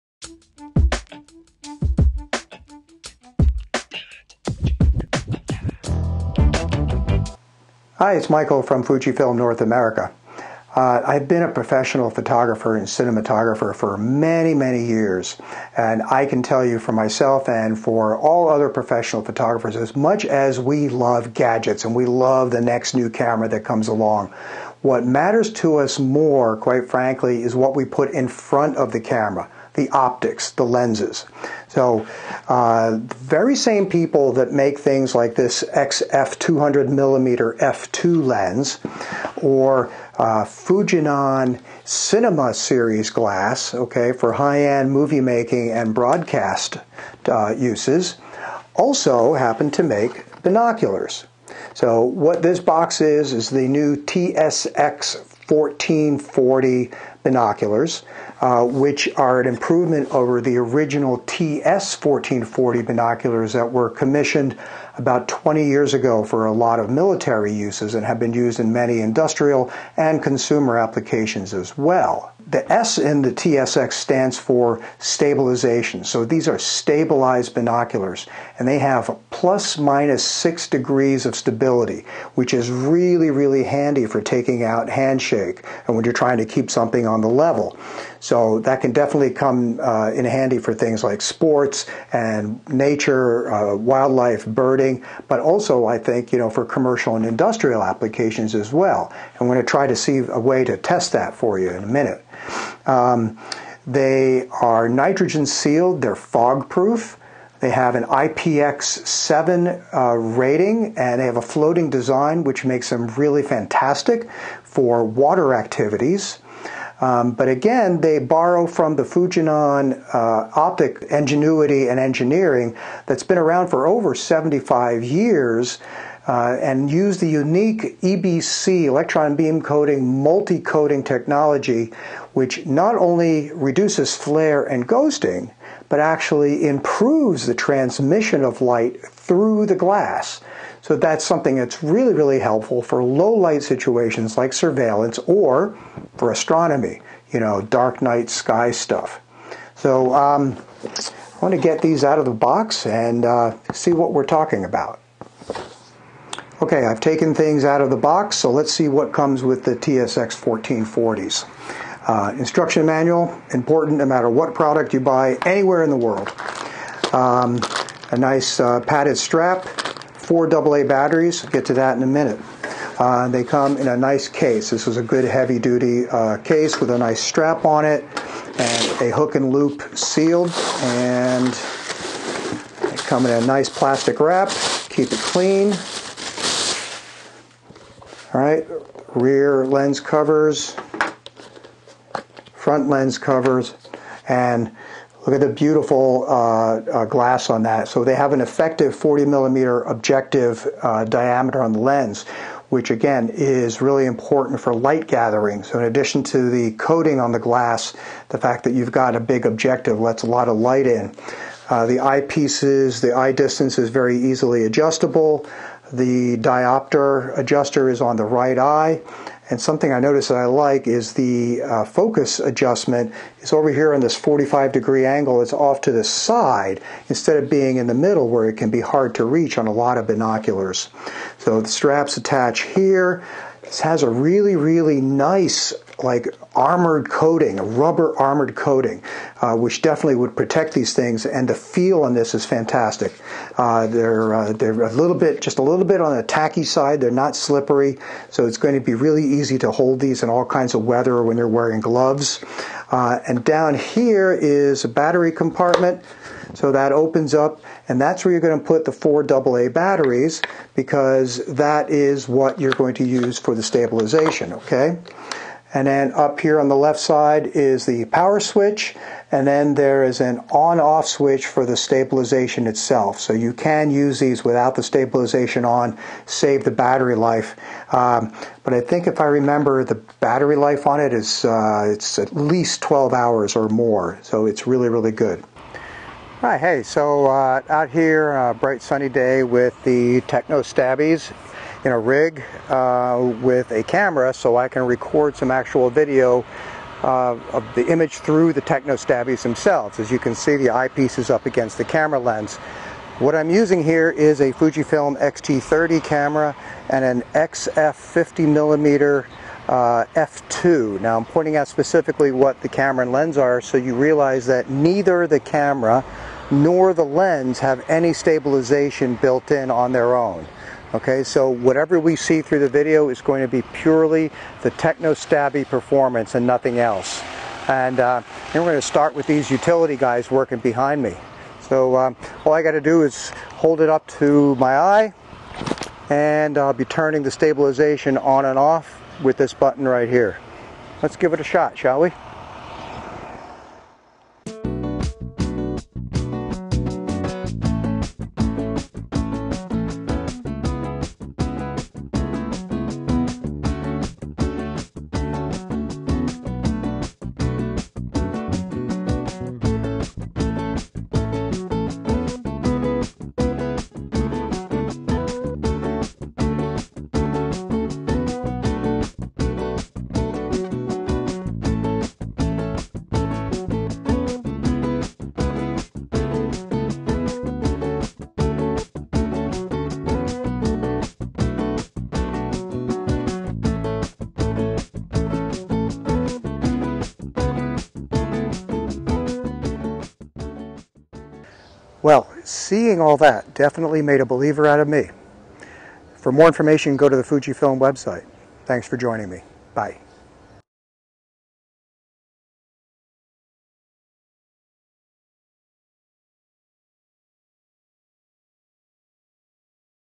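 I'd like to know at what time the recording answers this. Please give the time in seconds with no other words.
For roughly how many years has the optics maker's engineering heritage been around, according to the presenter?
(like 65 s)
123 s.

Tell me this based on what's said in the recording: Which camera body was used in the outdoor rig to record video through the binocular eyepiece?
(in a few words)
Fujifilm X-T30.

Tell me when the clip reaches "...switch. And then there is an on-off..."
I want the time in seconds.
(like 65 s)
268 s.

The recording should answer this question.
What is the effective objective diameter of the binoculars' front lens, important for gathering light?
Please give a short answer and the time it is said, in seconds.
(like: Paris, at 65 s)
40 millimeters, at 198 s.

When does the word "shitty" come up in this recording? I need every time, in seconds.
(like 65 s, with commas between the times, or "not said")
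not said.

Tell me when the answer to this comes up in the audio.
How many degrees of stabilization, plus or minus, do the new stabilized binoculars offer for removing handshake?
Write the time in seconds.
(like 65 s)
79 s.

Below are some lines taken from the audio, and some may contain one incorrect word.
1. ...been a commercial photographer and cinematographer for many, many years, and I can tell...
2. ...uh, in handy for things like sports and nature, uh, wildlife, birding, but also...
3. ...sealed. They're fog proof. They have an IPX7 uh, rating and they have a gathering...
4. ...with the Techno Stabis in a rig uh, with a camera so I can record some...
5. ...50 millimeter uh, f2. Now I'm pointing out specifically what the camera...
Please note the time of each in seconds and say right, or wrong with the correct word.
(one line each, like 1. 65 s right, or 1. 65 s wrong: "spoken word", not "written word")
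1. 11 s wrong: "professional", not "commercial"
2. 89 s right
3. 105 s wrong: "floating", not "gathering"
4. 289 s right
5. 307 s right.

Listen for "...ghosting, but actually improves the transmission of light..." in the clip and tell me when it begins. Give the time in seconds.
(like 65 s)
134 s.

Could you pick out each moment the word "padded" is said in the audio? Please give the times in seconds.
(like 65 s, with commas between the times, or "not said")
168 s.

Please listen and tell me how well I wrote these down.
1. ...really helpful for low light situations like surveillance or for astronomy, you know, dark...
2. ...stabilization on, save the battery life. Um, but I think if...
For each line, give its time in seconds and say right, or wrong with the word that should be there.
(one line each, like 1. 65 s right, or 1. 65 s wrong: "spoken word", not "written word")
1. 142 s right
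2. 274 s right.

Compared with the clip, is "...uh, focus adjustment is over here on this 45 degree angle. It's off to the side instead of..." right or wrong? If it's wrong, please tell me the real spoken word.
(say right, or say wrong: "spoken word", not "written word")
right.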